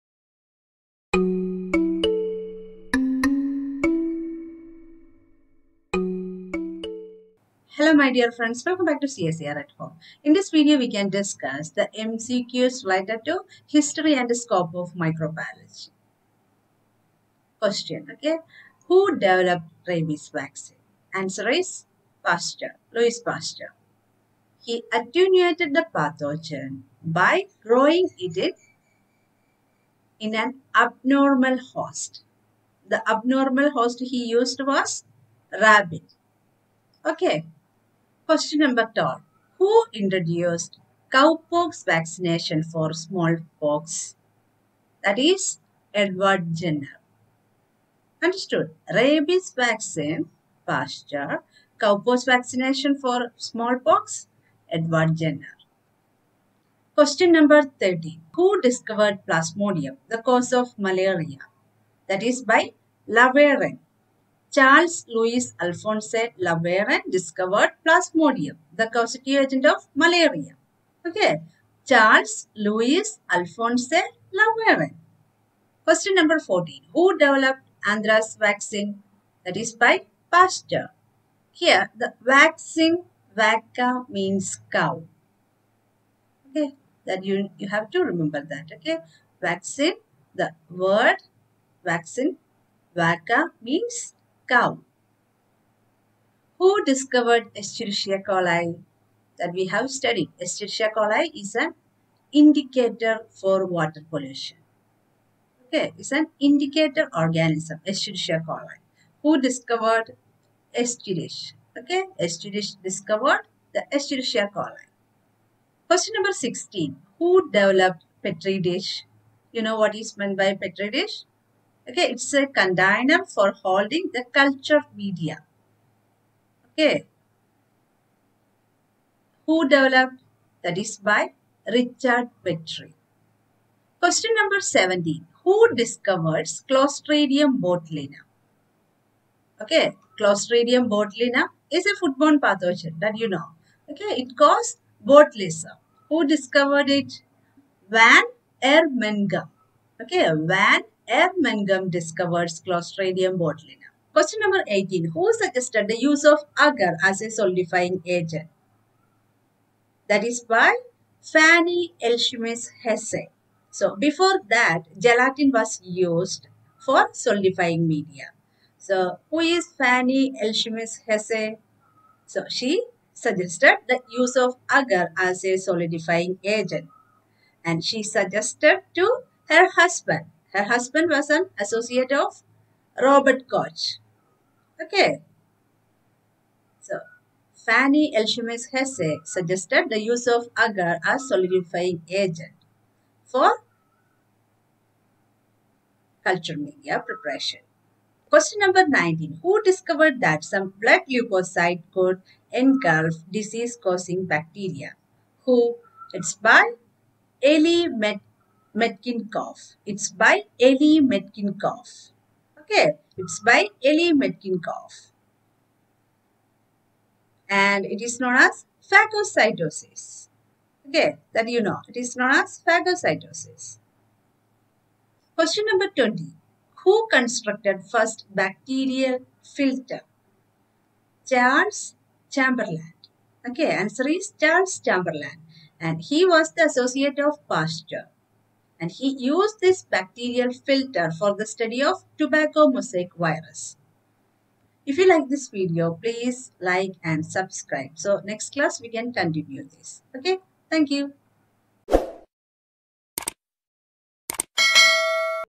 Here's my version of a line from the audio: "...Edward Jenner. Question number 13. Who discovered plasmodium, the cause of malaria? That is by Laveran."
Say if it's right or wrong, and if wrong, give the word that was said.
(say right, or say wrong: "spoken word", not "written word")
right.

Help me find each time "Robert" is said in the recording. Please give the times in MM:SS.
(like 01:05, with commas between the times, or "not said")
03:03.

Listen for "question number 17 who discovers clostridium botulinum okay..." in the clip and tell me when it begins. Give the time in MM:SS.
02:13.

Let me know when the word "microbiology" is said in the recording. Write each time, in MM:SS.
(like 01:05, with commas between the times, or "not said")
00:14.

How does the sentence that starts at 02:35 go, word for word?
Who suggested the use of agar as a solidifying agent?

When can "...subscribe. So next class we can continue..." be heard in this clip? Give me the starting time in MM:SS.
04:07.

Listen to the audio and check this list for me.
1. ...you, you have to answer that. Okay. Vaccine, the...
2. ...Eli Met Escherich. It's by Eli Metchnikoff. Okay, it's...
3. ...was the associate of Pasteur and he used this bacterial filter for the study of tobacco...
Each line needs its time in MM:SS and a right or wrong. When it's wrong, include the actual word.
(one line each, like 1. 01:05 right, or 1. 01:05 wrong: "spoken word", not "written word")
1. 01:27 wrong: "remember", not "answer"
2. 03:27 wrong: "Metchnikoff", not "Escherich"
3. 03:56 right.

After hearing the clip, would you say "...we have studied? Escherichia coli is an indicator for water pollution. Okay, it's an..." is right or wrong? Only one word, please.
right.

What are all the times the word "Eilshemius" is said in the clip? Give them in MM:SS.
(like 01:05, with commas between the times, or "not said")
02:42, 02:50, 03:08.